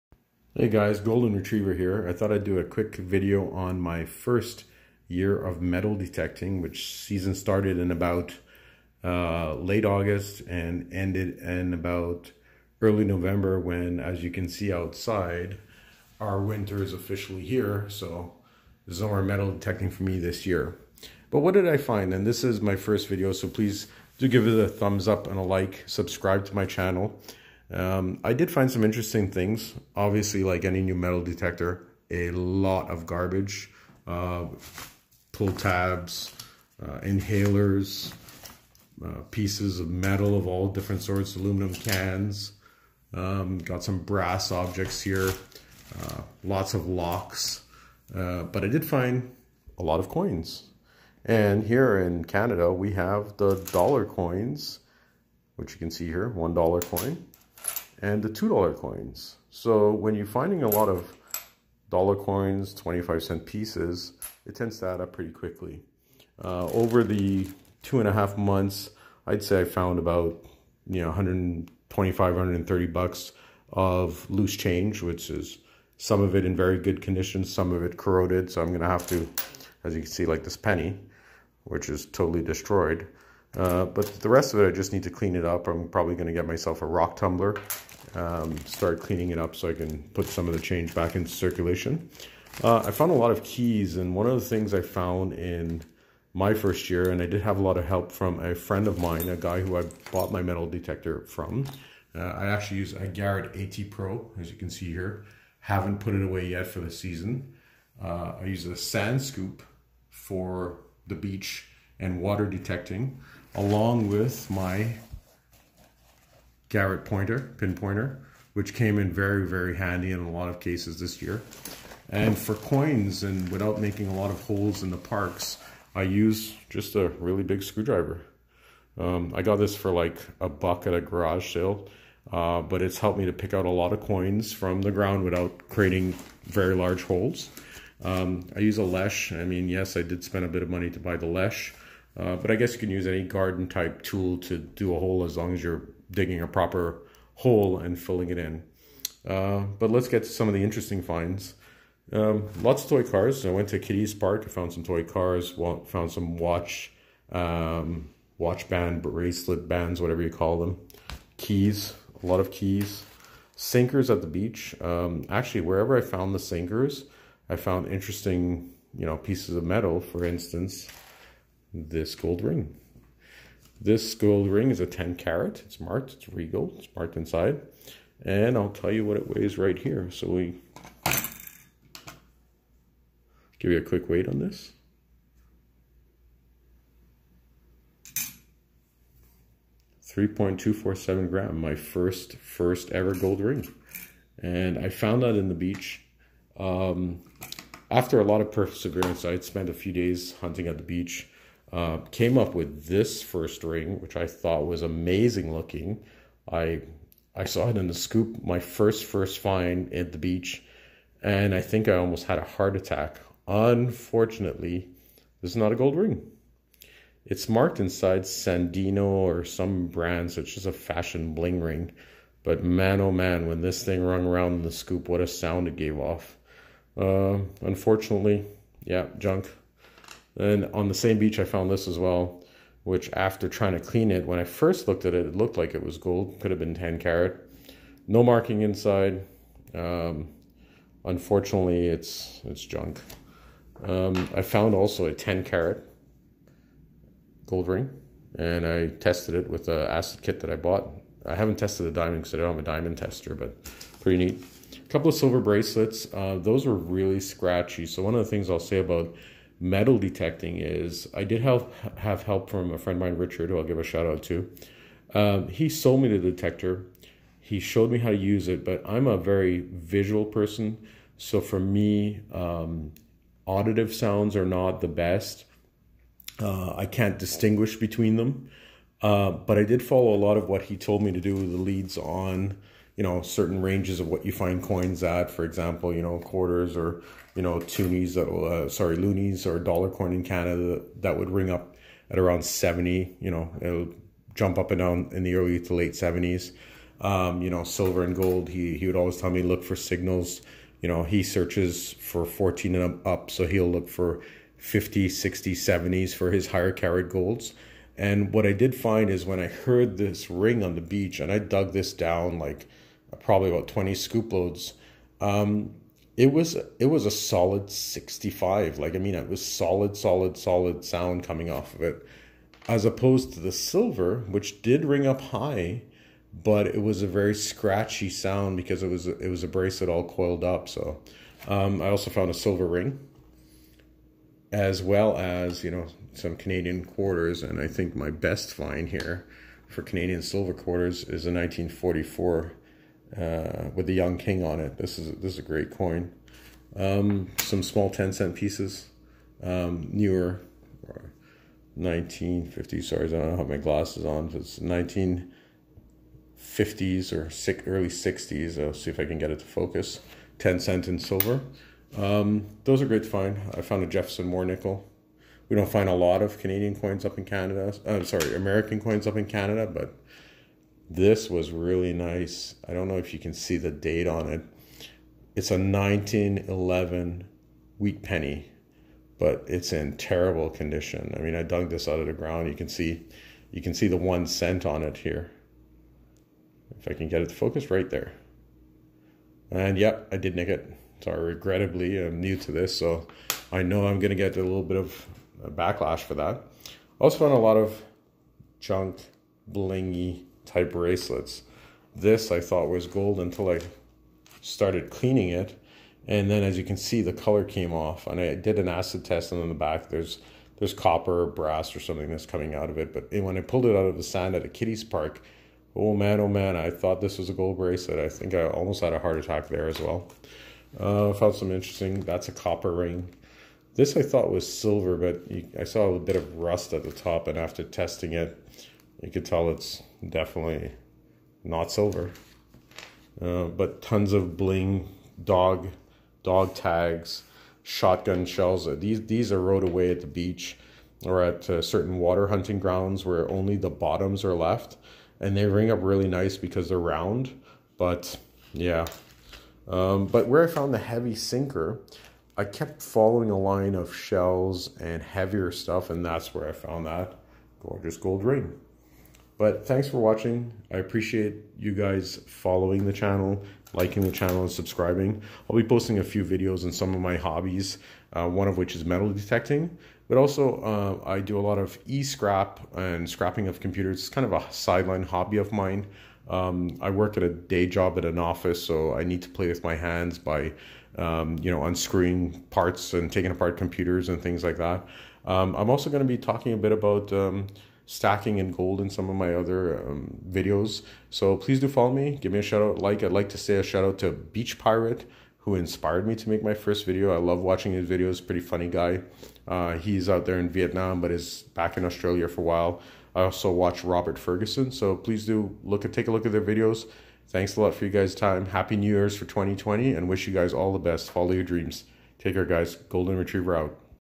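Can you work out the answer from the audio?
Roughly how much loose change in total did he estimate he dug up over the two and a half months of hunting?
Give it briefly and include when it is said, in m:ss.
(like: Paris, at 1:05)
125, 130 bucks, at 1:11.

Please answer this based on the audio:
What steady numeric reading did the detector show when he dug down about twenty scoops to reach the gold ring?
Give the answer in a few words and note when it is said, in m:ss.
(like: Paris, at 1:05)
65, at 5:17.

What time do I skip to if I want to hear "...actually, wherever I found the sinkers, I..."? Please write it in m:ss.
2:45.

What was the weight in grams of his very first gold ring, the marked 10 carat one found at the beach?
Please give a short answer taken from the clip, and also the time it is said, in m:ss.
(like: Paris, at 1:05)
3.247 grams, at 3:10.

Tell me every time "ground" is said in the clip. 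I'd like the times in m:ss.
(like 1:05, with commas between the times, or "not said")
2:14, 6:22, 7:22.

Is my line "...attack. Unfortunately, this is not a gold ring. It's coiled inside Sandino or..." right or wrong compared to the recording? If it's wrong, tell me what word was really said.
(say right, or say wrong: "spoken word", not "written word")
wrong: "marked", not "coiled".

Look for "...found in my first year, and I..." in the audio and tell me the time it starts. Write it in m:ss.
1:34.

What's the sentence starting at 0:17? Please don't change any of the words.
So there's no more metal detecting for me this year.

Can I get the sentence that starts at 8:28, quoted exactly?
Happy New Year's for 2020 and wish you guys all the best.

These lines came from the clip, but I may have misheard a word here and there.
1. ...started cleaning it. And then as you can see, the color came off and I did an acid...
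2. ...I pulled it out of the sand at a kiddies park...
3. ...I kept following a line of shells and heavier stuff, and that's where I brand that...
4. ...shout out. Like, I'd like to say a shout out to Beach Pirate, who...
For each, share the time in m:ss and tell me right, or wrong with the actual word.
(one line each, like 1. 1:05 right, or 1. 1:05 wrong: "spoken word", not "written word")
1. 6:44 right
2. 6:53 right
3. 7:32 wrong: "found", not "brand"
4. 8:12 right.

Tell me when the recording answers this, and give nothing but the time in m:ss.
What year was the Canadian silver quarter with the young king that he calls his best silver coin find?
5:41.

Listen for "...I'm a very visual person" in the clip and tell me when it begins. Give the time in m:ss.
4:28.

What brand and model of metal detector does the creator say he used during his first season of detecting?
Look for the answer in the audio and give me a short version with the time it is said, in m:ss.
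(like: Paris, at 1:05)
Garrett AT Pro, at 1:43.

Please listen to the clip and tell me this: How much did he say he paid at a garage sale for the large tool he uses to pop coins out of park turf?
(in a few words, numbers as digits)
a buck.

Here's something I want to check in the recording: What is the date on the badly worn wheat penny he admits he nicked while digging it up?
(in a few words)
1911.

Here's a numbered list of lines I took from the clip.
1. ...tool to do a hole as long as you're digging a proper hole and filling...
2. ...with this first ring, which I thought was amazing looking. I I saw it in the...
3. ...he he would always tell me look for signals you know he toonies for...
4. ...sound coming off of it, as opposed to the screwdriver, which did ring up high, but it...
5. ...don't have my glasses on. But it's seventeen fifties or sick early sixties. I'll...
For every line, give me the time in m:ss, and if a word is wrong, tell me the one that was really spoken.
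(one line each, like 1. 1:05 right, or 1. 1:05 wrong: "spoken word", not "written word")
1. 2:24 right
2. 3:22 right
3. 4:58 wrong: "searches", not "toonies"
4. 5:20 wrong: "silver", not "screwdriver"
5. 5:53 wrong: "nineteen", not "seventeen".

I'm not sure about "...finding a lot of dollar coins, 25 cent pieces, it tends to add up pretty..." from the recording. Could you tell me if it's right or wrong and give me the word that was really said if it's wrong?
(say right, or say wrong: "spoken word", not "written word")
right.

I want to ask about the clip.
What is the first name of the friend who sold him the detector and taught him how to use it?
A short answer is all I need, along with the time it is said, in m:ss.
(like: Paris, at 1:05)
Richard, at 4:23.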